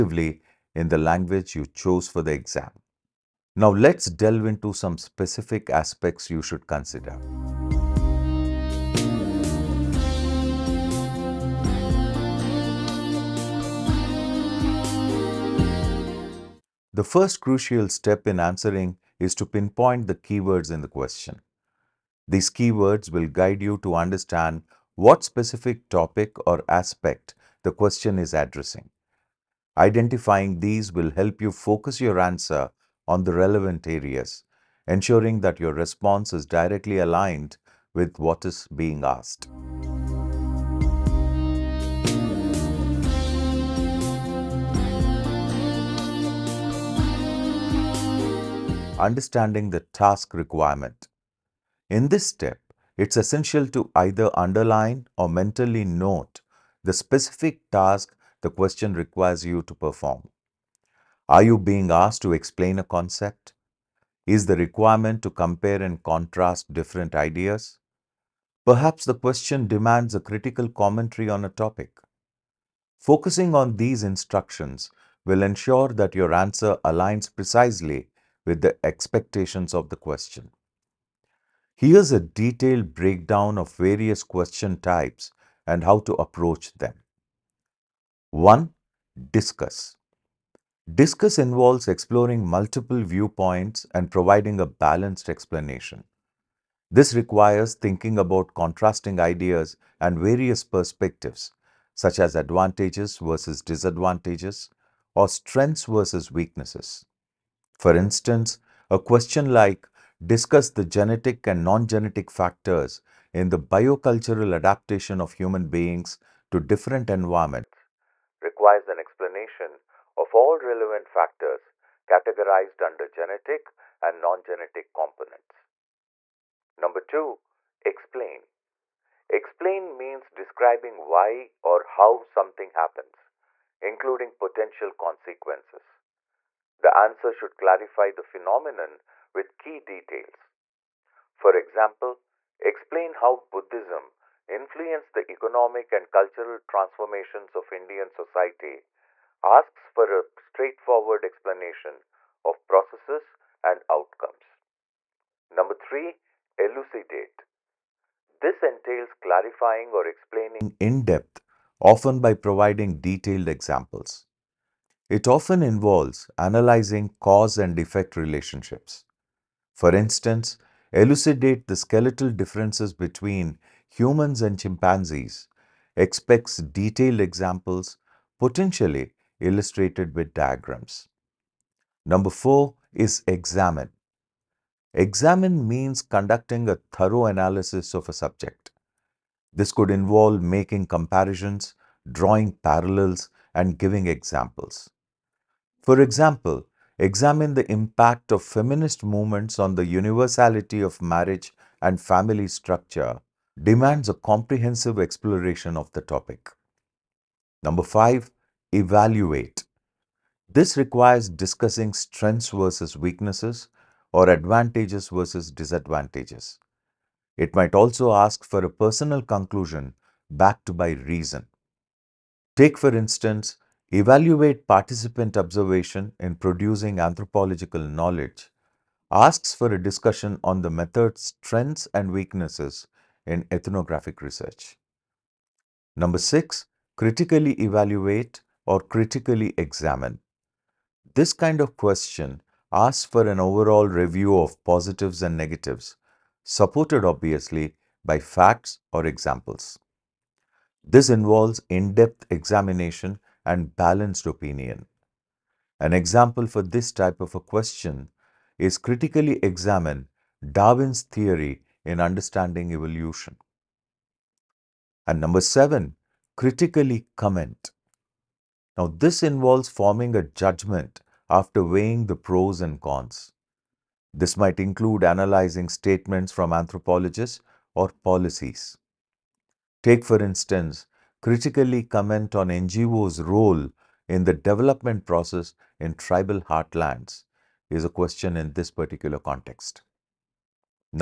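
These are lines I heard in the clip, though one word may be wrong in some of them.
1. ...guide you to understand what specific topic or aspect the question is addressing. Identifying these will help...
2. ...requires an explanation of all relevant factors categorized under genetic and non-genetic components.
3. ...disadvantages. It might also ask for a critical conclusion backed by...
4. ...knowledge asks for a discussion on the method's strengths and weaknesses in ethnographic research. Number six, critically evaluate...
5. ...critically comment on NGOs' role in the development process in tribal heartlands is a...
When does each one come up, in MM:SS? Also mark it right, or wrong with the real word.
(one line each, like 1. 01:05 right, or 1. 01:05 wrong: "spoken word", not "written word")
1. 00:23 right
2. 01:58 right
3. 03:35 wrong: "personal", not "critical"
4. 03:47 right
5. 04:41 right.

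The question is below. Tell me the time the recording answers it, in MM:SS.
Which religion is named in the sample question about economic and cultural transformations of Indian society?
02:23.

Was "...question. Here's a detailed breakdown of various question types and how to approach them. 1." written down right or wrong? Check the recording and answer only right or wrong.
right.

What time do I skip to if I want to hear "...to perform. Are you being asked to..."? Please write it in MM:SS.
00:59.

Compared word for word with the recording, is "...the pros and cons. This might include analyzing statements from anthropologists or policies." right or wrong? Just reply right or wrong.
right.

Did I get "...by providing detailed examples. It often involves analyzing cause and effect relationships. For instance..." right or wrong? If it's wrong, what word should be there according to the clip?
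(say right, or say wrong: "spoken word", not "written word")
right.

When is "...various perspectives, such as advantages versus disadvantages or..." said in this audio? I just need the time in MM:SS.
01:40.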